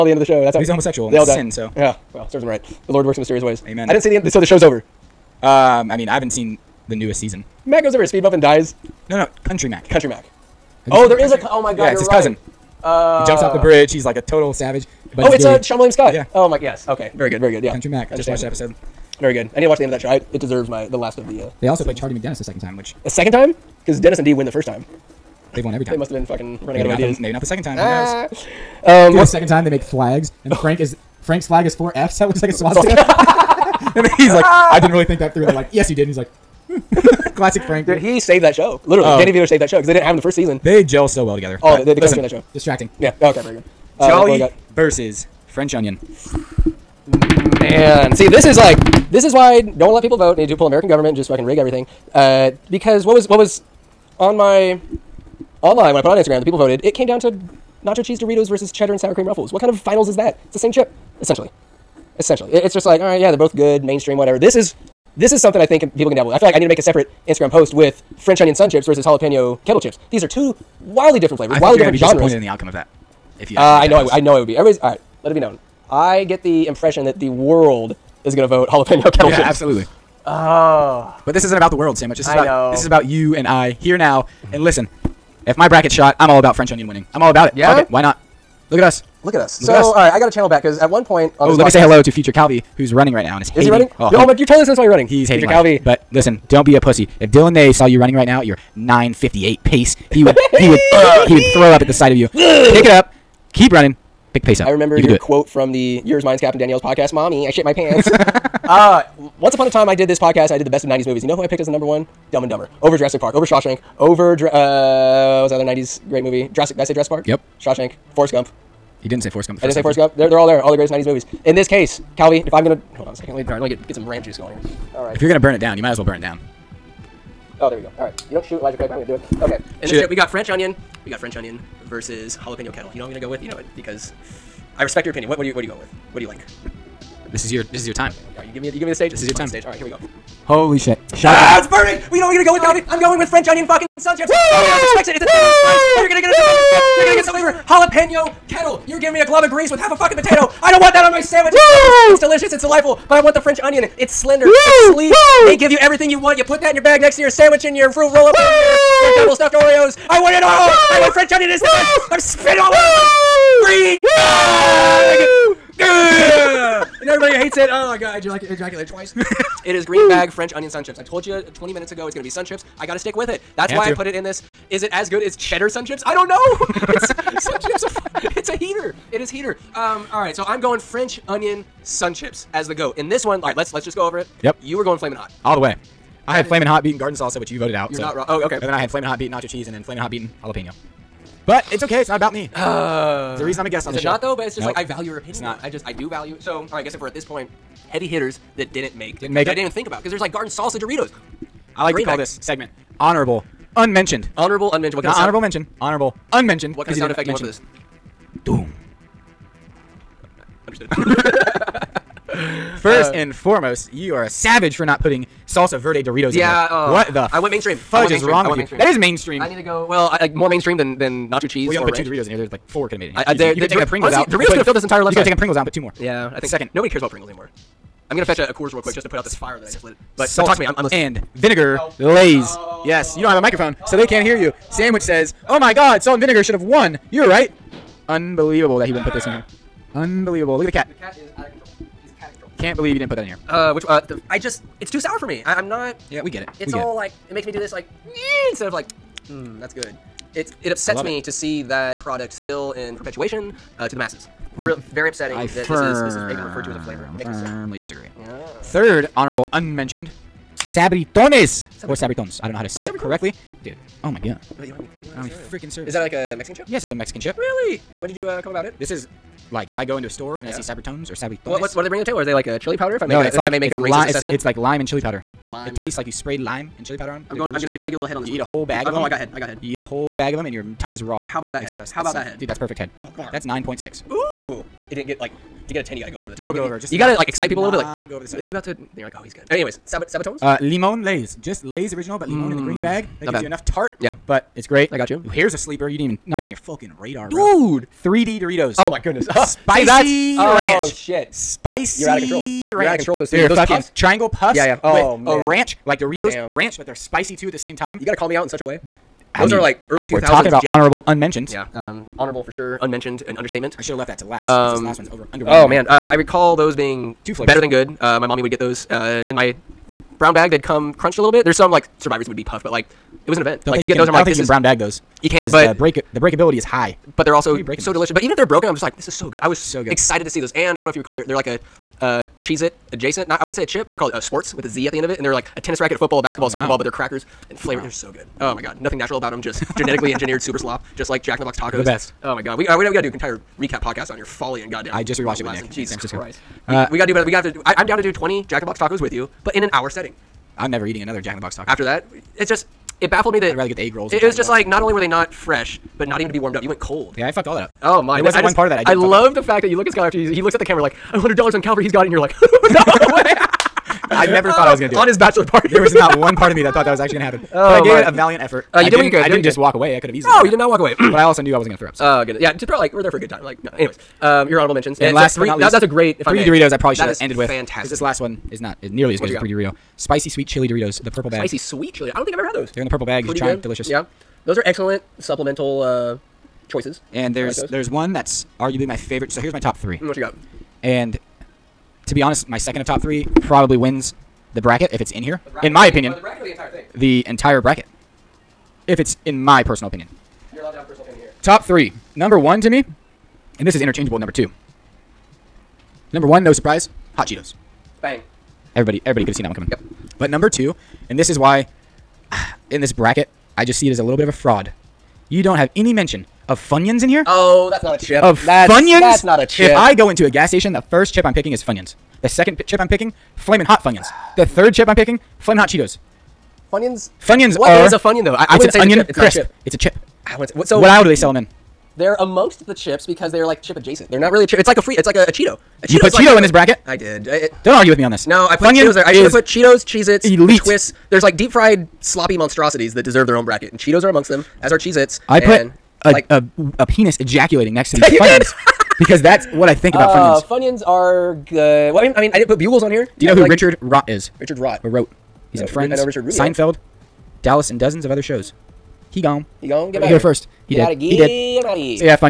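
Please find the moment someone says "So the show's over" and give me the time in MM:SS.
00:04.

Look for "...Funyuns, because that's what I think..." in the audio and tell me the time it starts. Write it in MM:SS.
07:28.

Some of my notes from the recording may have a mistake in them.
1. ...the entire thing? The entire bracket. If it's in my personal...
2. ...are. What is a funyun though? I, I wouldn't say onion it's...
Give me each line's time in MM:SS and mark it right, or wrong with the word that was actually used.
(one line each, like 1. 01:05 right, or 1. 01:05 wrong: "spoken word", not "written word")
1. 06:36 right
2. 07:07 right.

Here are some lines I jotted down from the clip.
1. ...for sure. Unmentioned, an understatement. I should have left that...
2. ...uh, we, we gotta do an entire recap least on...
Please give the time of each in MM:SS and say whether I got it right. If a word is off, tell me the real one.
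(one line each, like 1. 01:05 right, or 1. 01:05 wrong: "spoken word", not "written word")
1. 05:12 right
2. 05:42 wrong: "podcast", not "least".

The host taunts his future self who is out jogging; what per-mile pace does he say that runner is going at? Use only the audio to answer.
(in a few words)
9:58.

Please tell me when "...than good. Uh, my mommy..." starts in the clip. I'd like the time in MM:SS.
05:17.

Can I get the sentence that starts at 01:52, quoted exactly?
Over Jurassic Park, over Shawshank, over, uh, what's another '90s great movie?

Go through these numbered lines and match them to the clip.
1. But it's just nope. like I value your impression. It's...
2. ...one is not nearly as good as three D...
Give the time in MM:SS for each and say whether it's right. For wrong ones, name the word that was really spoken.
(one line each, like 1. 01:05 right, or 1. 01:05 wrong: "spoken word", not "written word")
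1. 03:14 wrong: "opinion", not "impression"
2. 06:18 right.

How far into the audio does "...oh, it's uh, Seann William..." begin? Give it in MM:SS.
00:15.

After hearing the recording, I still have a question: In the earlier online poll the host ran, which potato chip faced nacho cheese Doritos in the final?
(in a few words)
Cheddar and sour cream Ruffles.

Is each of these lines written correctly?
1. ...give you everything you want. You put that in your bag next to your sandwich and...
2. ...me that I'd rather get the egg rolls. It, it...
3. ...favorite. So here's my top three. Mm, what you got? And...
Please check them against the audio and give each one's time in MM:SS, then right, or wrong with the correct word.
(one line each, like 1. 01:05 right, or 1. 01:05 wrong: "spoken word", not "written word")
1. 02:35 right
2. 05:53 right
3. 06:28 right.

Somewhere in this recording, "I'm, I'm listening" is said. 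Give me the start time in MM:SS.
03:50.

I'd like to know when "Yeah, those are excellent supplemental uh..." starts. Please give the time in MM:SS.
06:23.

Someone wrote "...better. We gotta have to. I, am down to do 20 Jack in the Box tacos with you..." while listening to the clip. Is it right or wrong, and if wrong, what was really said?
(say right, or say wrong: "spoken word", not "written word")
right.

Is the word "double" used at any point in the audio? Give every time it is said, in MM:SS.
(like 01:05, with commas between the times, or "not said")
02:39.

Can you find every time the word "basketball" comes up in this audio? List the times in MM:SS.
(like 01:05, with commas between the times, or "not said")
05:36.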